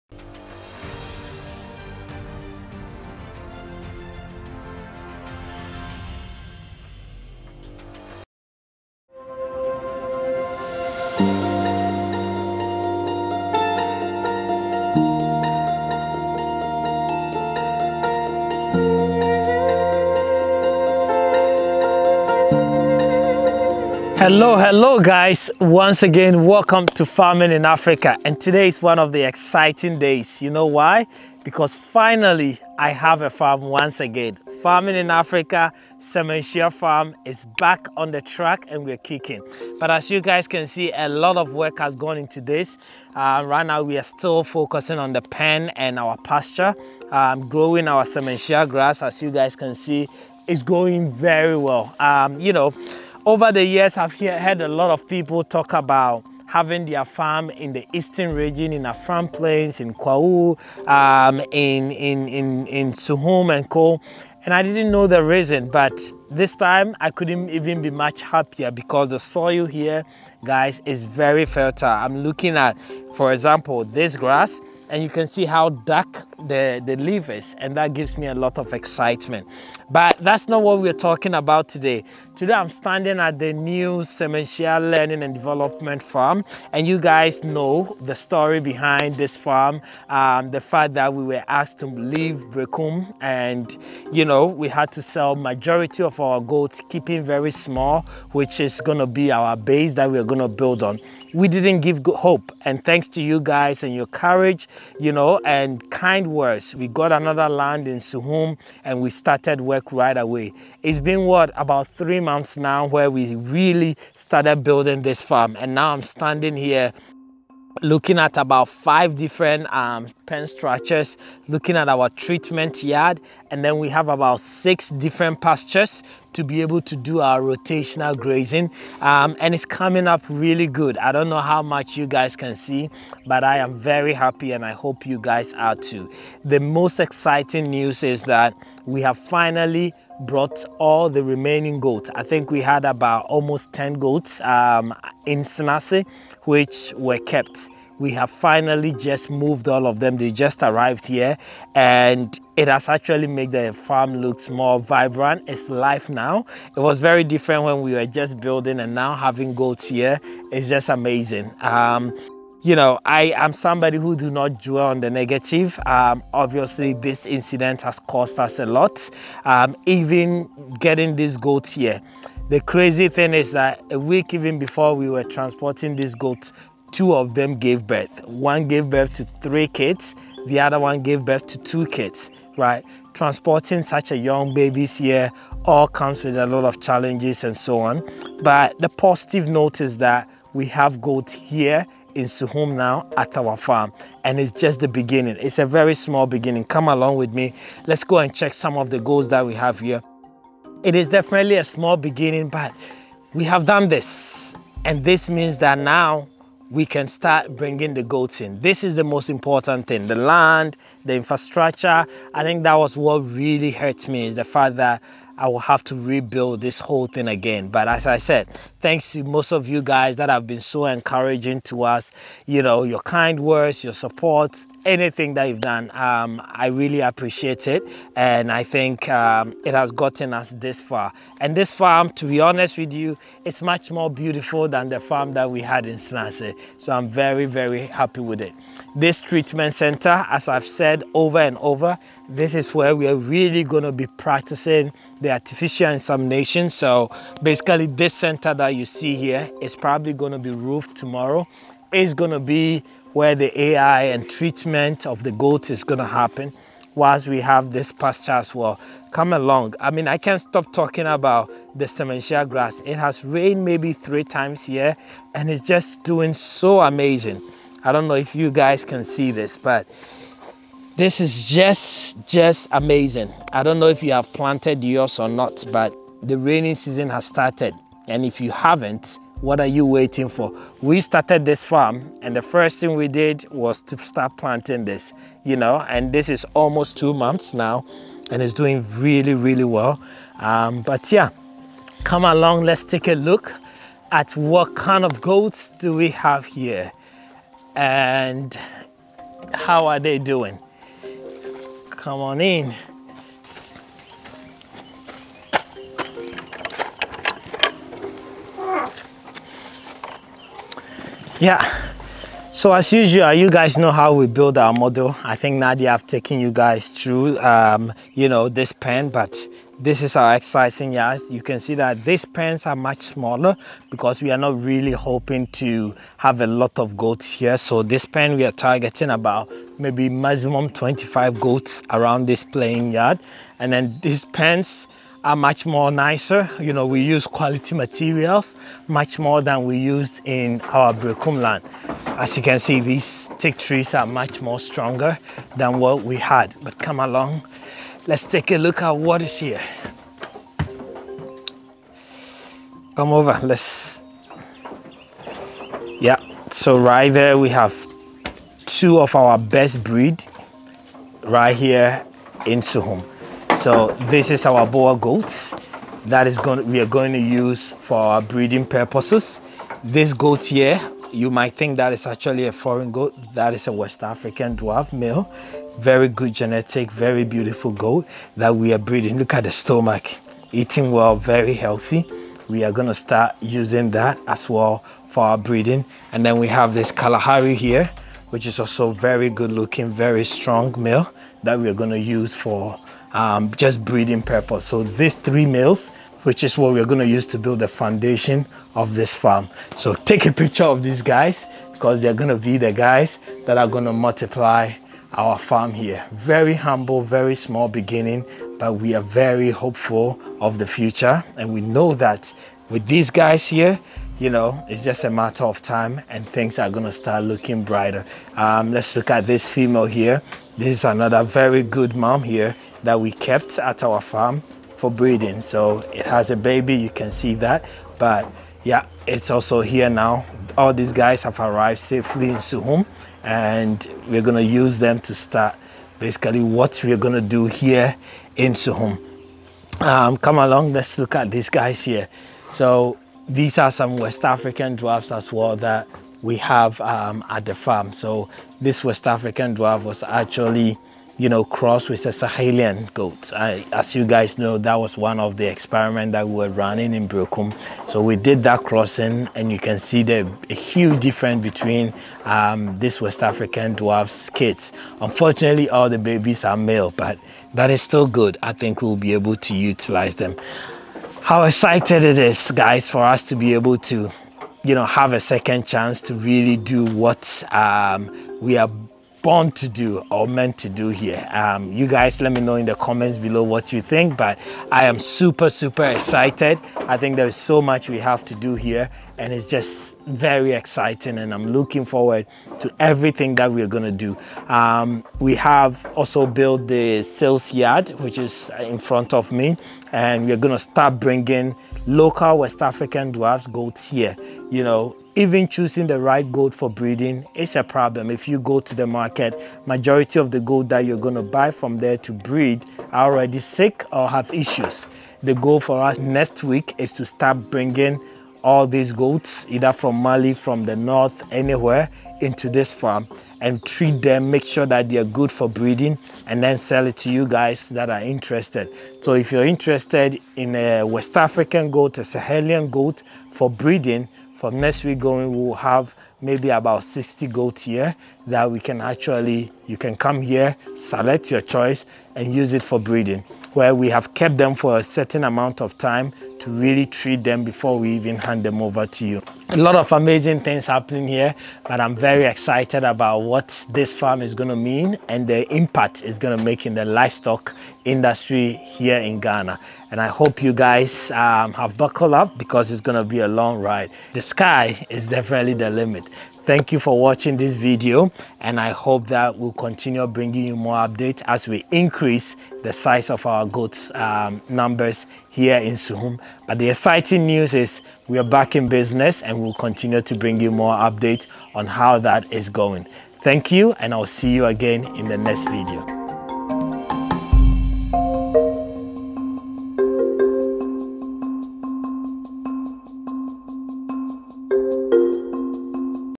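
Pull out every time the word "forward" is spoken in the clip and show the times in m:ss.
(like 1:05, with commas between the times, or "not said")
8:11.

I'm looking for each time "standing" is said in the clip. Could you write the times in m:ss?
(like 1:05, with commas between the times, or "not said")
1:22, 1:56.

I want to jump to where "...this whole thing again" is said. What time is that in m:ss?
3:36.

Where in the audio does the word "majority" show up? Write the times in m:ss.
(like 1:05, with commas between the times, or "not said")
1:35, 8:29.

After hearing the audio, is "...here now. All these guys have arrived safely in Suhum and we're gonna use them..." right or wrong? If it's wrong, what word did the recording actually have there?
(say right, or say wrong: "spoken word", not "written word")
right.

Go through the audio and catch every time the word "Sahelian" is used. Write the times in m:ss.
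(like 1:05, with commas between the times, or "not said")
7:32, 8:52.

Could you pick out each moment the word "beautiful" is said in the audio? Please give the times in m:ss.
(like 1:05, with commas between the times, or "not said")
3:54, 6:17.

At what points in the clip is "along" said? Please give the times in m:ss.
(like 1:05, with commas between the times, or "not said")
3:16, 4:19, 4:52, 5:46, 7:20.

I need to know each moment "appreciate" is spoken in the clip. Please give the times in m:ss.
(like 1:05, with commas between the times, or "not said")
3:46.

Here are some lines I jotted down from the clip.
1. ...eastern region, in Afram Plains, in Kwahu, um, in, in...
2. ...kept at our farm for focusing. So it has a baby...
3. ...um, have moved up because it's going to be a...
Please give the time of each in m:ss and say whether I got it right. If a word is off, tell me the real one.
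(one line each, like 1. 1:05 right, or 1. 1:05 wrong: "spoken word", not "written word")
1. 0:57 right
2. 7:03 wrong: "breeding", not "focusing"
3. 9:21 wrong: "buckled", not "moved".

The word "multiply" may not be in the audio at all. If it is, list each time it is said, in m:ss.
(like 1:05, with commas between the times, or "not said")
6:43.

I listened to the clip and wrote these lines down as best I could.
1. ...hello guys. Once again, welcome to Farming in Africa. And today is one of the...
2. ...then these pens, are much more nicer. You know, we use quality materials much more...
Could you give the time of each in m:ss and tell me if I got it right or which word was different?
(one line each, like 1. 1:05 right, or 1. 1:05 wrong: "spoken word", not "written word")
1. 0:24 right
2. 5:33 right.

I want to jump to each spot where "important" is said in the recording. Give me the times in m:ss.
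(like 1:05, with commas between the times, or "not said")
3:29.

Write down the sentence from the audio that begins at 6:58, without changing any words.
Um, let's look at this female here.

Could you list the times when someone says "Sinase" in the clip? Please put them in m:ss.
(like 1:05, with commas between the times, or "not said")
2:25.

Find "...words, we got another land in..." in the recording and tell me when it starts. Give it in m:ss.
1:46.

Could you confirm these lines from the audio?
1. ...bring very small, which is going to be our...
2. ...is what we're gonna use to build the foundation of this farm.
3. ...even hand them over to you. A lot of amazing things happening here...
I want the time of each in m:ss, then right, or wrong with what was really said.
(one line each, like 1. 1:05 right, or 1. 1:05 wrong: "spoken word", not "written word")
1. 1:36 wrong: "keeping", not "bring"
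2. 6:36 right
3. 9:07 right.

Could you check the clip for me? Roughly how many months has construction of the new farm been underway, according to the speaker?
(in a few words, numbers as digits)
3.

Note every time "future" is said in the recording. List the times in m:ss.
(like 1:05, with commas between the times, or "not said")
6:50.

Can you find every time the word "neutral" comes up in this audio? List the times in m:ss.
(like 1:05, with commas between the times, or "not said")
not said.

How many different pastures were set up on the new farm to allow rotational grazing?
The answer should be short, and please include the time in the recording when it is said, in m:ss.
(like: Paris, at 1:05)
6, at 2:04.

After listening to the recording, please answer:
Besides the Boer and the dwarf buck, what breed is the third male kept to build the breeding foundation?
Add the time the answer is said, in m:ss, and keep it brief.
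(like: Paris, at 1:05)
Kalahari, at 6:26.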